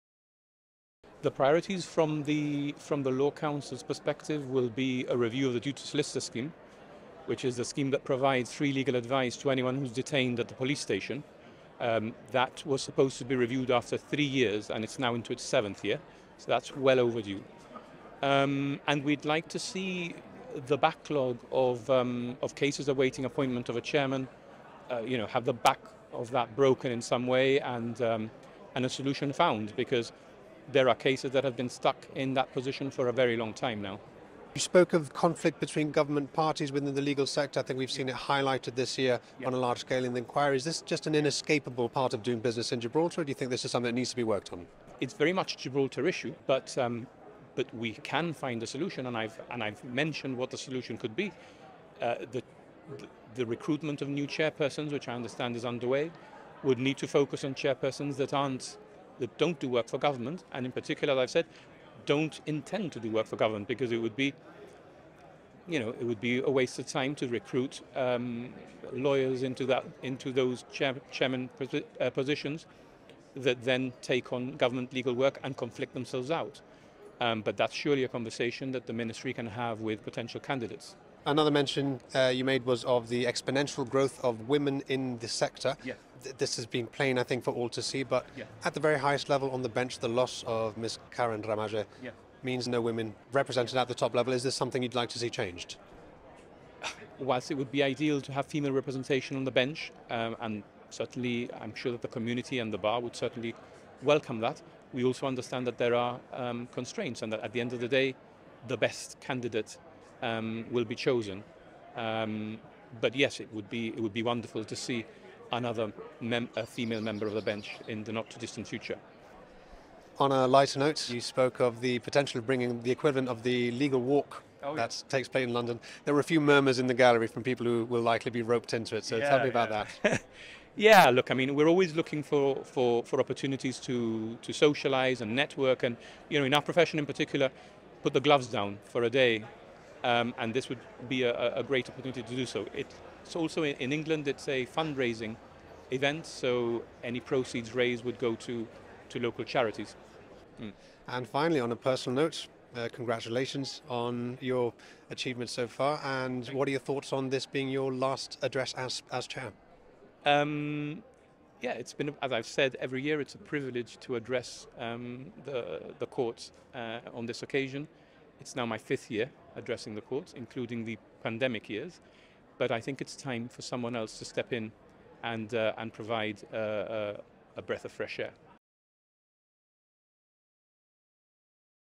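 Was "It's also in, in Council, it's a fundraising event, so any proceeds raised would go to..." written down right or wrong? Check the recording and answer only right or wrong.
wrong.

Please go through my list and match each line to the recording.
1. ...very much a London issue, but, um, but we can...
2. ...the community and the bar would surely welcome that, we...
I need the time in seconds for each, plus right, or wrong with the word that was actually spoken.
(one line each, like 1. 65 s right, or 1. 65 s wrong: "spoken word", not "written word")
1. 45 s wrong: "Gibraltar", not "London"
2. 102 s wrong: "certainly", not "surely".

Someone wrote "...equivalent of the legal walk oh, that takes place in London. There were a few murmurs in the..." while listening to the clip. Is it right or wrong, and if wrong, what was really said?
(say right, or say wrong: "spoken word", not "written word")
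right.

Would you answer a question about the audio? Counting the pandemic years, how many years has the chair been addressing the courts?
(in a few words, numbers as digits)
5.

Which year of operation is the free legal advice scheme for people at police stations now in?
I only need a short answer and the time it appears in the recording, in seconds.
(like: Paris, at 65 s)
7th, at 15 s.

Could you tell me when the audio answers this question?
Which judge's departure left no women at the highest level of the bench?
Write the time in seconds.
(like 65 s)
91 s.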